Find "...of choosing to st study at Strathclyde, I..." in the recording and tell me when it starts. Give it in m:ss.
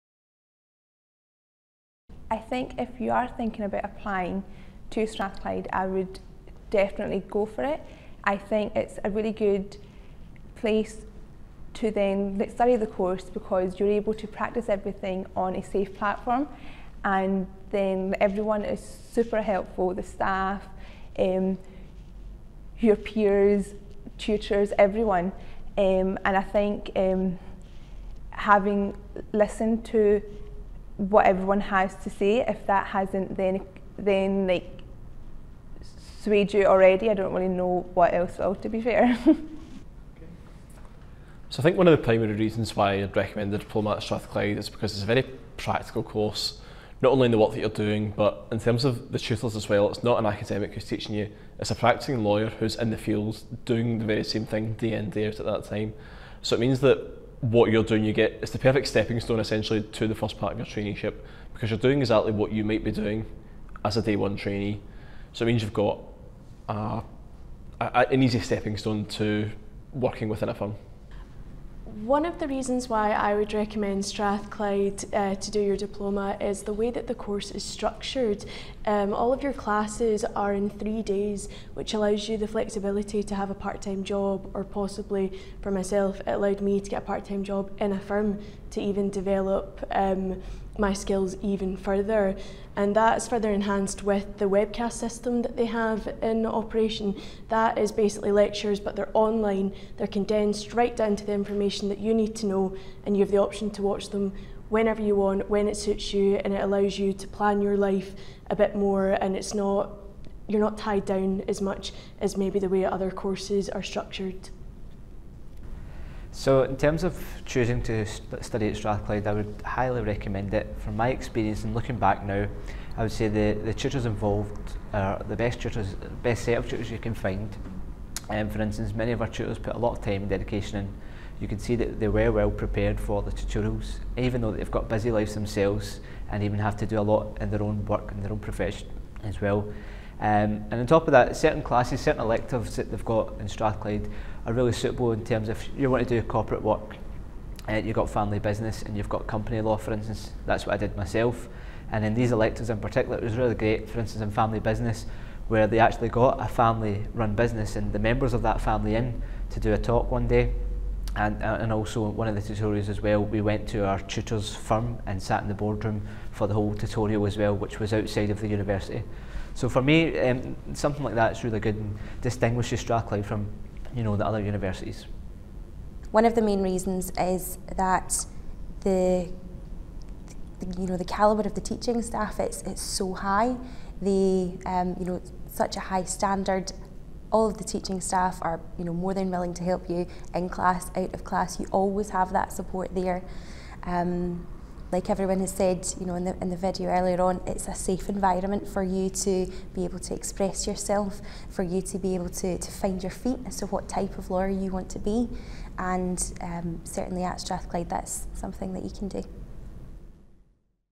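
1:57.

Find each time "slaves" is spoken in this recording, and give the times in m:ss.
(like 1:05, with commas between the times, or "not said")
not said.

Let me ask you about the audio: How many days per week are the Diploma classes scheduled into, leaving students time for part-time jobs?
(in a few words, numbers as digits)
3.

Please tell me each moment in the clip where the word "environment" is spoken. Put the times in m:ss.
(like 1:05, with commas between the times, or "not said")
3:18.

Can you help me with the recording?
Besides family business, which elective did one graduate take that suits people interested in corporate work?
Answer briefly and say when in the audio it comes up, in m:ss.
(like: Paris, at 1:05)
company law, at 2:29.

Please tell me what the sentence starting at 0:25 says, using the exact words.
Um, and I think um, having listened to what everyone has to say.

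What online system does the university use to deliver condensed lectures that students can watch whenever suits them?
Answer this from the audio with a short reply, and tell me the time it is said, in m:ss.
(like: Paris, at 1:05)
webcast system, at 1:34.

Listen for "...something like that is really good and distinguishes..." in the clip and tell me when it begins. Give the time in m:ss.
2:50.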